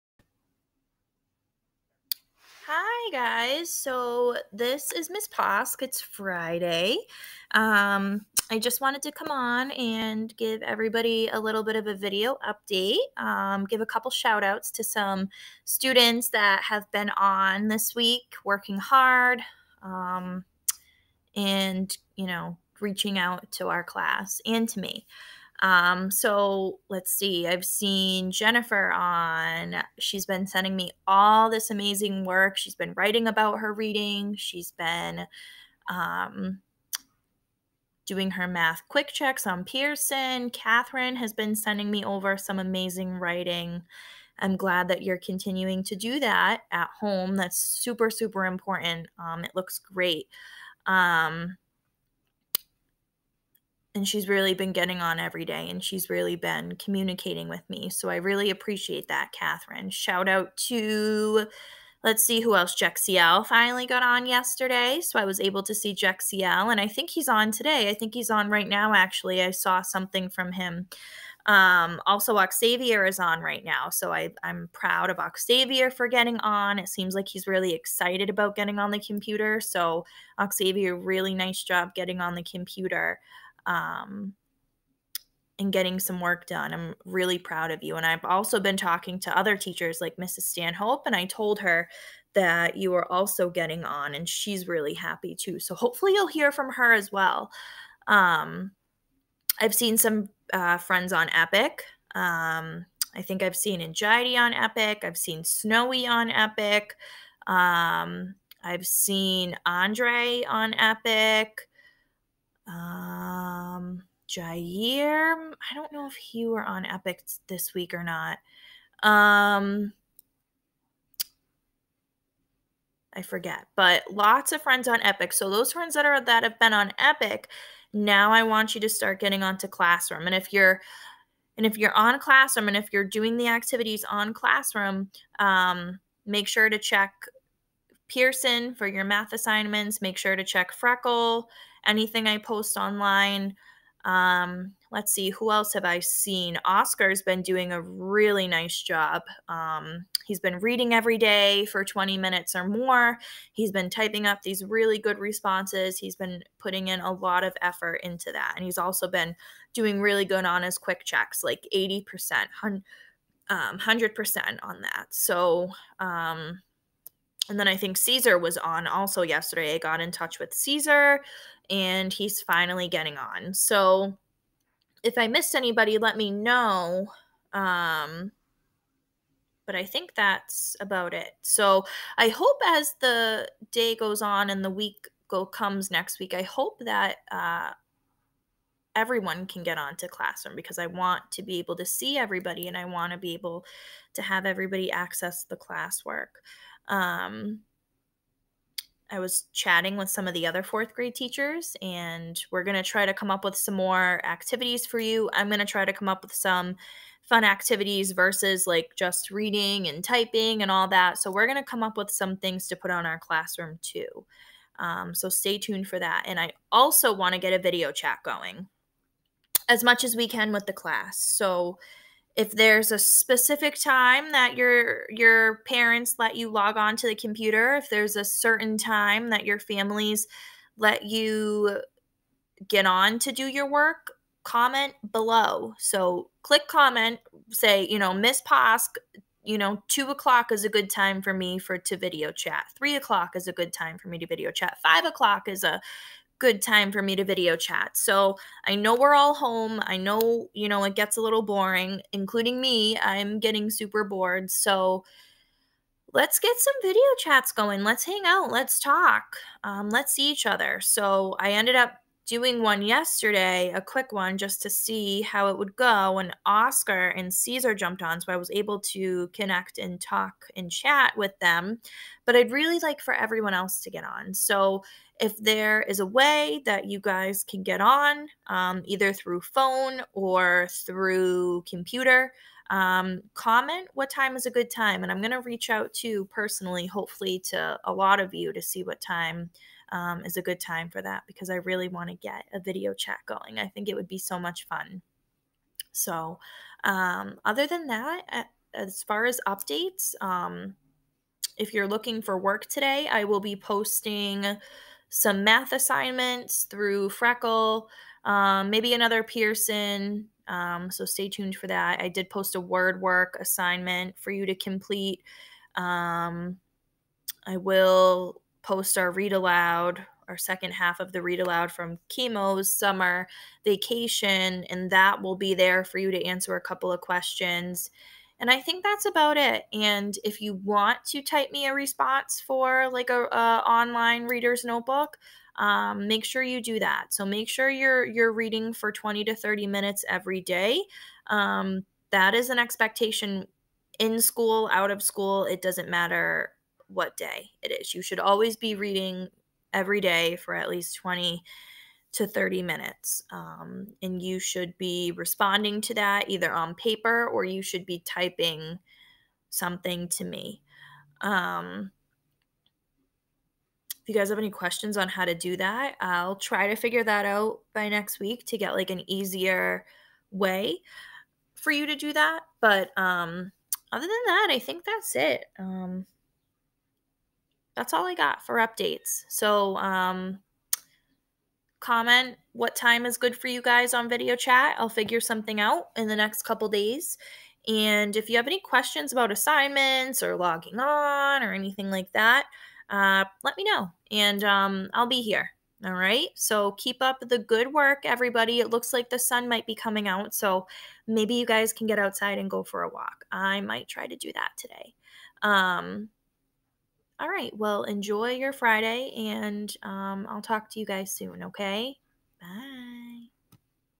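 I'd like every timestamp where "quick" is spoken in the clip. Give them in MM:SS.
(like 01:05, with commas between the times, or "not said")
00:38, 02:40, 04:23.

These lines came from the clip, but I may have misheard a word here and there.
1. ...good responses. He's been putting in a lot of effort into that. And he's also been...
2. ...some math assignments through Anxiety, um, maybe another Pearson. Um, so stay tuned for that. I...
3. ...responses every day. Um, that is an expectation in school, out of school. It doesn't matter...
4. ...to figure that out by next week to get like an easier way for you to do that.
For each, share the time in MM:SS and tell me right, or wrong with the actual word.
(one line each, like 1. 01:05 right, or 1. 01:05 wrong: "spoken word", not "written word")
1. 02:34 right
2. 05:05 wrong: "Freckle", not "Anxiety"
3. 05:39 wrong: "minutes", not "responses"
4. 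06:06 right.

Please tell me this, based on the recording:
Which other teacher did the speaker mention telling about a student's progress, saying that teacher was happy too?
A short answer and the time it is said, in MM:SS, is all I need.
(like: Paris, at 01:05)
Mrs. Stanhope, at 01:30.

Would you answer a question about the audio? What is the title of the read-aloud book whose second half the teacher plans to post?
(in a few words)
Chemo's Summer Vacation.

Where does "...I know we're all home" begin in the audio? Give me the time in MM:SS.
04:08.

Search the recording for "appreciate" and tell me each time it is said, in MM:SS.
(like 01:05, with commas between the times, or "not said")
00:58.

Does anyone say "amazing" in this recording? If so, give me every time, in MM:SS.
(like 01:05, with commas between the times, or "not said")
00:31, 00:42.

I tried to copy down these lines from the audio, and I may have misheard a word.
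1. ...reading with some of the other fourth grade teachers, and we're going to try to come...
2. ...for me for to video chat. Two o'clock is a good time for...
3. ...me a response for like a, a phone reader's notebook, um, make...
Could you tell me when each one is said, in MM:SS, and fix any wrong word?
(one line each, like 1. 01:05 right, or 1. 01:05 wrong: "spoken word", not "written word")
1. 03:19 wrong: "chatting", not "reading"
2. 04:01 wrong: "Three", not "Two"
3. 05:31 wrong: "online", not "phone".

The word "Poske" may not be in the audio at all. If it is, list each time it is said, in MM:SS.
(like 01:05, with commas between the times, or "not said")
00:05, 03:58.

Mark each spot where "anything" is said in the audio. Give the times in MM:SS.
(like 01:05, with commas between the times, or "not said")
02:21, 06:31.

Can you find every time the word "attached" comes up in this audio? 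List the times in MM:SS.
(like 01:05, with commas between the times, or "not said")
not said.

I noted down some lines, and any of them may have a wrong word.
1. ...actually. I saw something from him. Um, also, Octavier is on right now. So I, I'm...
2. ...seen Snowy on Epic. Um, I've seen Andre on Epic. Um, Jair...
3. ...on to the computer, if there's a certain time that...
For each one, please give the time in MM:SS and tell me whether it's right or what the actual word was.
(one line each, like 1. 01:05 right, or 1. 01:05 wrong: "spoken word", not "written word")
1. 01:08 right
2. 01:45 right
3. 03:46 right.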